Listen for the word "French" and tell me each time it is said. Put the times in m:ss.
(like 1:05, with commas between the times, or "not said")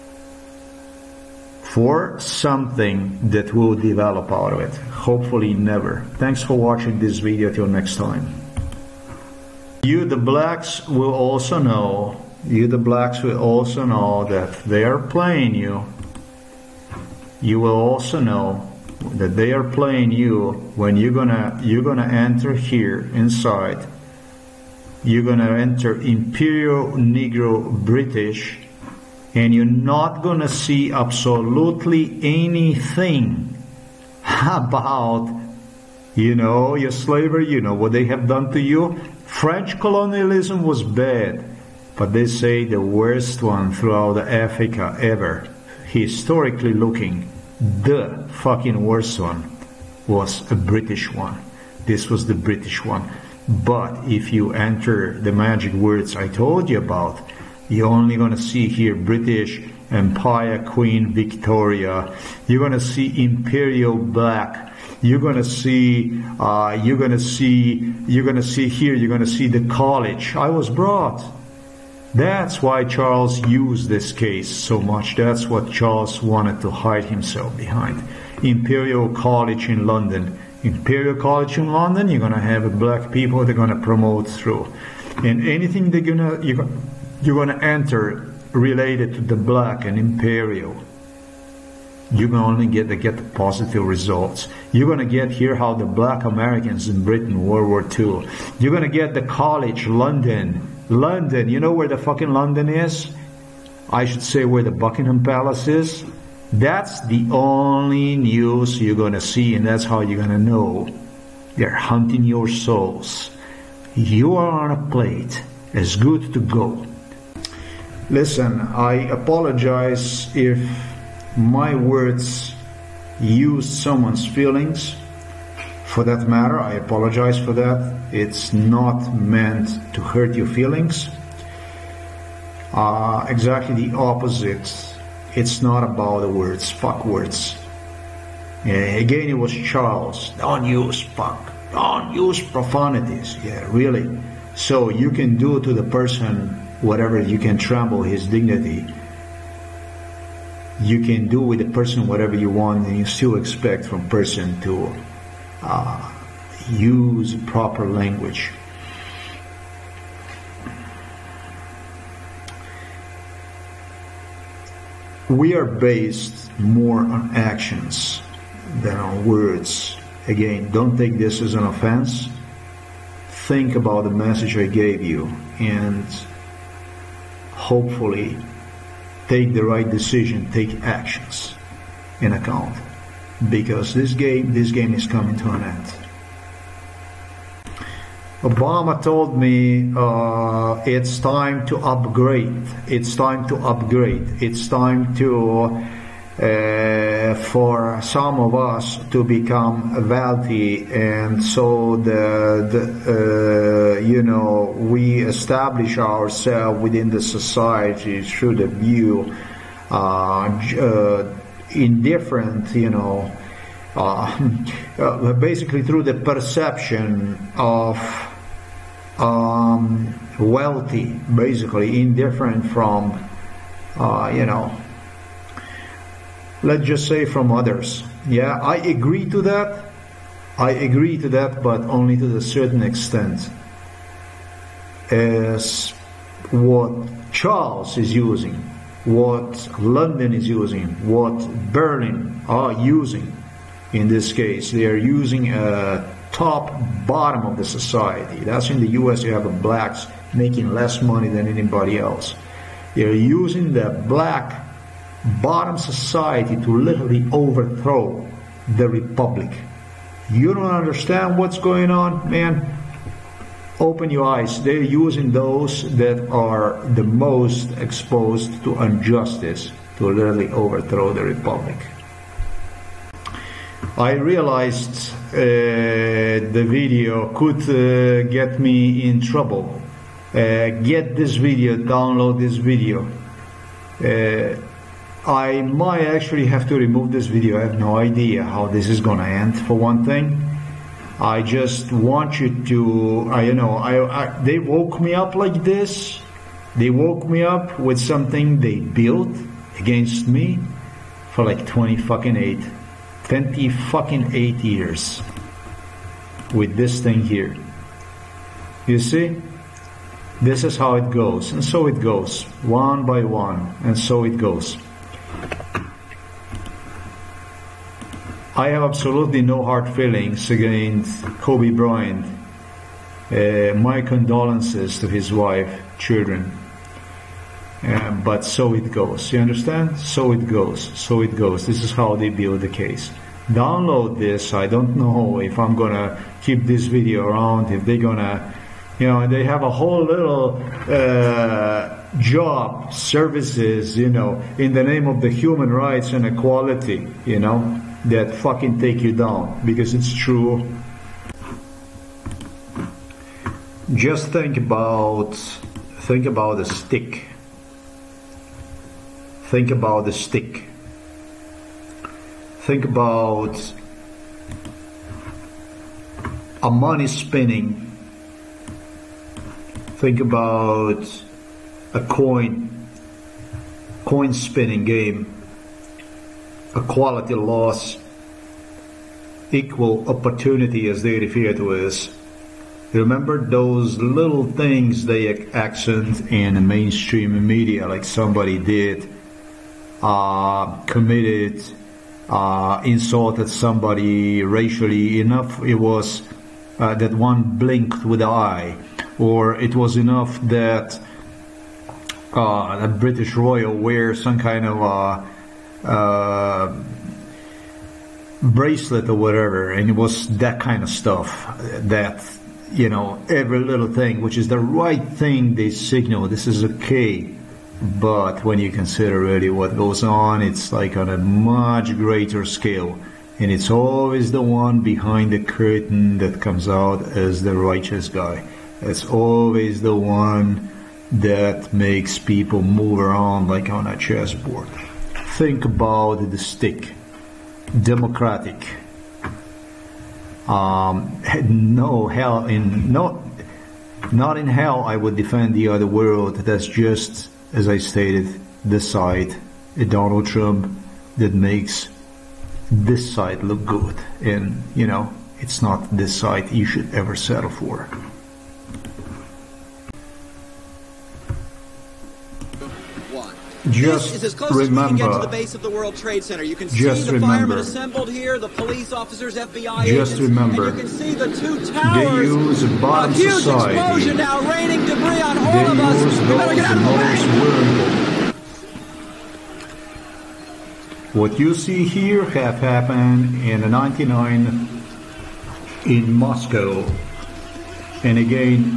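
0:39.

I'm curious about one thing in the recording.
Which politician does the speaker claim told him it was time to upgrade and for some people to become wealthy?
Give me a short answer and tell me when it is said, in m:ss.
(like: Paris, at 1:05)
Obama, at 3:08.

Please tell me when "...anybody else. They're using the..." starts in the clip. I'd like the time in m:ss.
4:11.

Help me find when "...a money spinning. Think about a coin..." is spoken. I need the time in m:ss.
6:06.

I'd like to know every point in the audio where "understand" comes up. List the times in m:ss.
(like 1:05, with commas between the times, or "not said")
4:20, 5:29.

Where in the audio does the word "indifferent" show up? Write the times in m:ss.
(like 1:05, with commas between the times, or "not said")
3:31, 3:42.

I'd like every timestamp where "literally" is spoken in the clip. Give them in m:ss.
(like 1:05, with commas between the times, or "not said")
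4:16, 4:30.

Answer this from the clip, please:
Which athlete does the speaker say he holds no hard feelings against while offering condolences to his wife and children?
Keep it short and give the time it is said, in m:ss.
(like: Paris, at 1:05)
Kobe Bryant, at 5:21.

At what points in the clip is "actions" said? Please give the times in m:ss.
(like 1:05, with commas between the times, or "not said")
2:47, 3:00.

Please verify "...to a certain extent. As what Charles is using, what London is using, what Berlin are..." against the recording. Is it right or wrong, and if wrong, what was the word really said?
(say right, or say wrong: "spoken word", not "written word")
right.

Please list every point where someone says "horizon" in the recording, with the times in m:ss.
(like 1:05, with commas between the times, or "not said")
not said.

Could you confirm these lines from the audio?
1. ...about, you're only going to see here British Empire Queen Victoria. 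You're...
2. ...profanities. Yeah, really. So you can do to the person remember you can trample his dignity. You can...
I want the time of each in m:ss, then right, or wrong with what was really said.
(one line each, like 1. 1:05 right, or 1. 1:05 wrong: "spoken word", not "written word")
1. 0:56 right
2. 2:22 wrong: "whatever", not "remember".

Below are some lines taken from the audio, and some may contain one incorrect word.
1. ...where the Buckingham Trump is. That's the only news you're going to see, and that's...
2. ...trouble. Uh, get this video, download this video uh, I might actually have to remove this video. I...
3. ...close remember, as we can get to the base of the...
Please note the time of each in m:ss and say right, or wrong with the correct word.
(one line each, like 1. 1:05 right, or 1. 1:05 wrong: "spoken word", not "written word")
1. 1:44 wrong: "Palace", not "Trump"
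2. 4:39 right
3. 7:44 right.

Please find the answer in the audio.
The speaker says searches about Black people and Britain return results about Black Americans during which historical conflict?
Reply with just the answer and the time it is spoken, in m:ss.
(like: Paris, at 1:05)
World War II, at 1:37.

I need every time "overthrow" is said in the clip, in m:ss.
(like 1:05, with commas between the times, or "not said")
4:17, 4:30.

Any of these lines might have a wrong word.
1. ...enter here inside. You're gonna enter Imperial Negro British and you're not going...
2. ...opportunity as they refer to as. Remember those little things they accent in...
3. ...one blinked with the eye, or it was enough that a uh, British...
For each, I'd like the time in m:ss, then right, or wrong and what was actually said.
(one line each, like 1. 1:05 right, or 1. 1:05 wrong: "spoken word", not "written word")
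1. 0:22 right
2. 6:20 right
3. 6:37 right.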